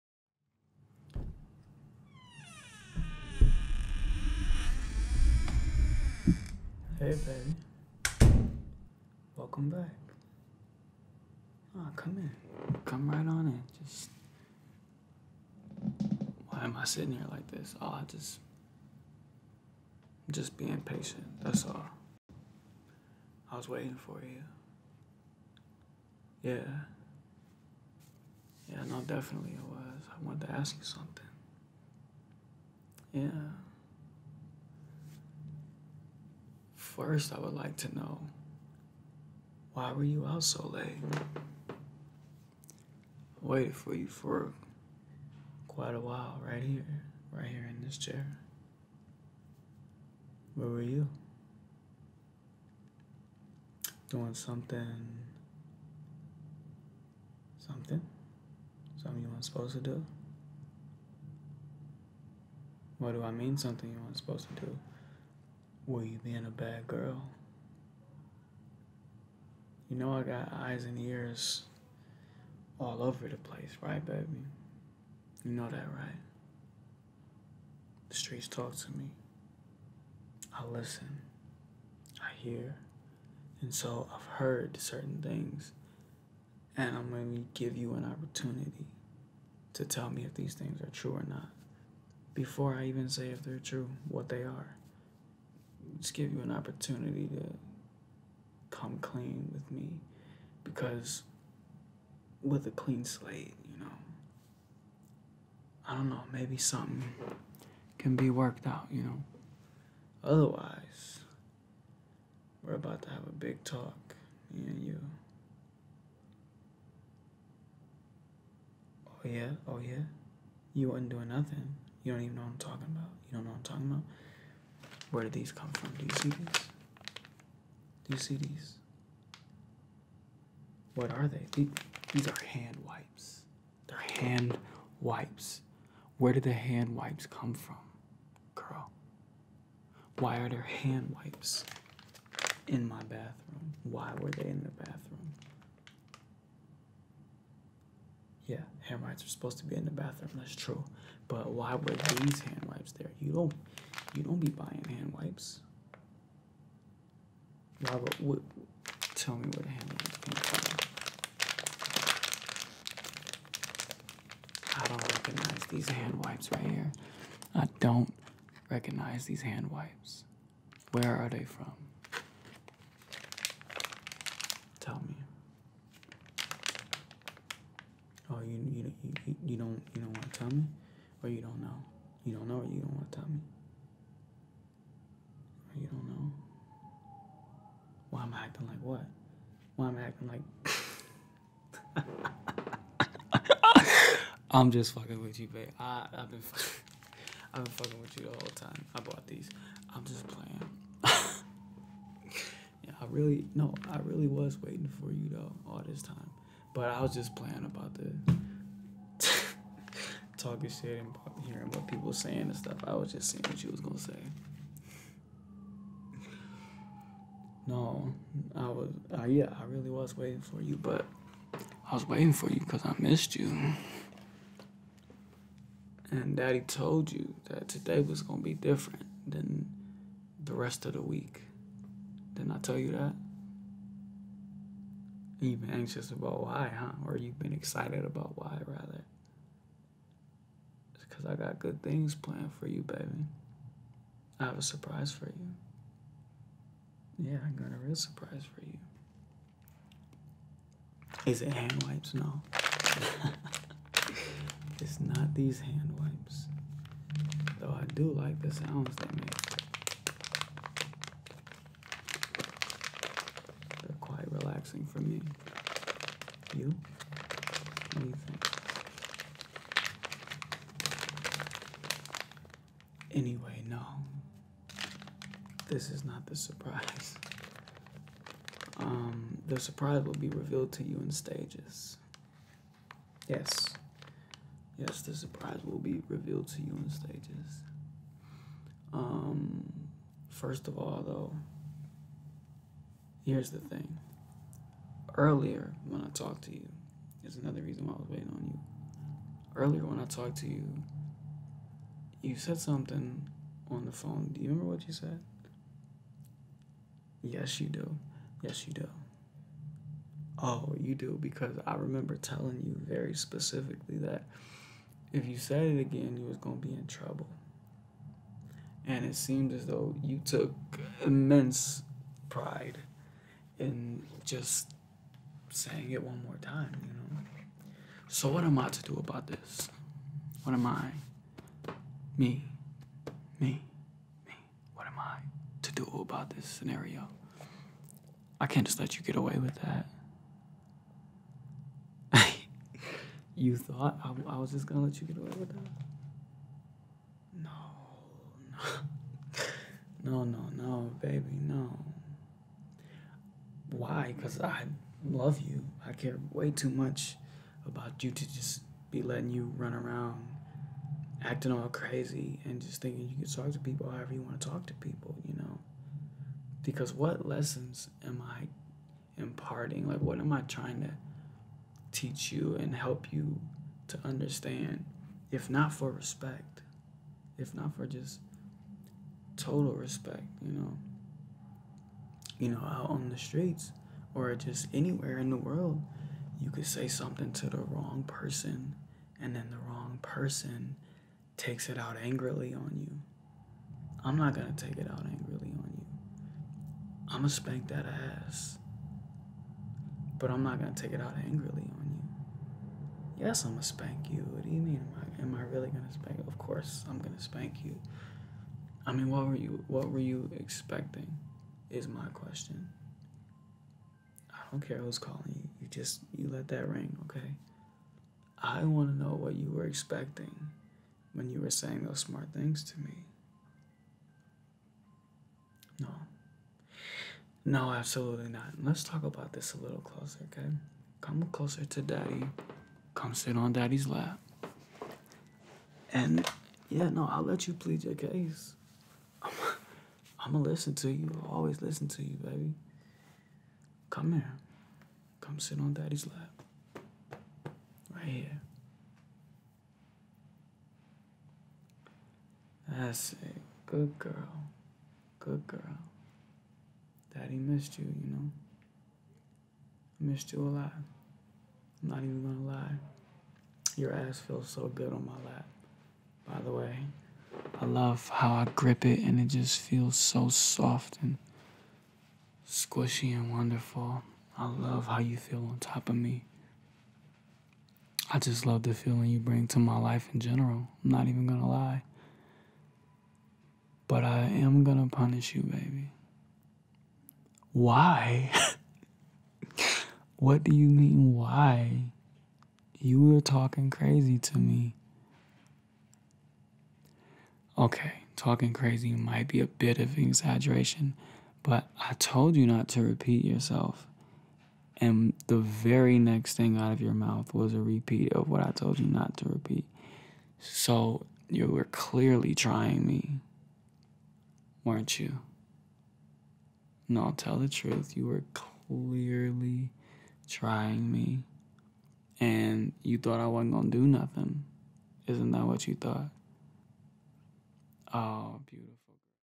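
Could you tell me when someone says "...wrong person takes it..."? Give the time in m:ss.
6:29.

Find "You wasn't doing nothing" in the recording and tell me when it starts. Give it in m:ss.
2:00.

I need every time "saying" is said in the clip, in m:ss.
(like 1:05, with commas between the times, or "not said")
3:32, 5:25, 7:01.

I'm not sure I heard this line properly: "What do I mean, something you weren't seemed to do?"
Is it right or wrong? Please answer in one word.
wrong.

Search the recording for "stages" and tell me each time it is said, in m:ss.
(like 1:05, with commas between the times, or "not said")
4:41, 4:46.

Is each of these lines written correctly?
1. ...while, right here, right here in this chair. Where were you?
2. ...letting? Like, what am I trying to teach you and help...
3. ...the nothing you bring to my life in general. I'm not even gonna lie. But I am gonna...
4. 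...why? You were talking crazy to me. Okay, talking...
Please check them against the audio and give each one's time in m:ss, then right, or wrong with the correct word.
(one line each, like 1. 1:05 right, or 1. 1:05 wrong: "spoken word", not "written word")
1. 0:46 right
2. 6:09 wrong: "imparting", not "letting"
3. 7:58 wrong: "feeling", not "nothing"
4. 8:11 right.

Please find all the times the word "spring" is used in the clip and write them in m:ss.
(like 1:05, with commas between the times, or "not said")
not said.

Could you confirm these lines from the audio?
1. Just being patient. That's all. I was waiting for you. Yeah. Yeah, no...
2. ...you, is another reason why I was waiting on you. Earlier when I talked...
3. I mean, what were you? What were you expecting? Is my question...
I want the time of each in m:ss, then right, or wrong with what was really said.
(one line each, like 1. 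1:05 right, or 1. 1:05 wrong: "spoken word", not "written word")
1. 0:20 right
2. 4:56 right
3. 6:48 right.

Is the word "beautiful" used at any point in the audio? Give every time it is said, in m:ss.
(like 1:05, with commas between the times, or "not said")
8:48.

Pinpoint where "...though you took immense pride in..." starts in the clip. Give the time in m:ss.
5:19.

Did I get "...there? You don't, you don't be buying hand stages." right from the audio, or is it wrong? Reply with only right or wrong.
wrong.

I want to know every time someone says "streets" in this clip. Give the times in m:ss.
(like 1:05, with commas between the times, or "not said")
1:18, 6:23.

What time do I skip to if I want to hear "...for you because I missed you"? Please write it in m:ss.
3:42.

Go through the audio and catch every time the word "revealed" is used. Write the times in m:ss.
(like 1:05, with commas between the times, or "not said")
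4:40, 4:46.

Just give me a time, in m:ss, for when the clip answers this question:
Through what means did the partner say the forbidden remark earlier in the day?
5:03.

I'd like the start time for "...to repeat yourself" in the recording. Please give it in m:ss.
8:22.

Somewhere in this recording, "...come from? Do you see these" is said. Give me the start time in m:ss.
2:05.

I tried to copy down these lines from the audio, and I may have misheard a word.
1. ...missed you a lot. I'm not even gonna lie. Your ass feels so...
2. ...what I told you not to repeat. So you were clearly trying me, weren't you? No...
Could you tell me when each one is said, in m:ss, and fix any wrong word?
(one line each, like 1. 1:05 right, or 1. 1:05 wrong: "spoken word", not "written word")
1. 7:40 right
2. 8:28 right.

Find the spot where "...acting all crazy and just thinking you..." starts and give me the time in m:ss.
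6:01.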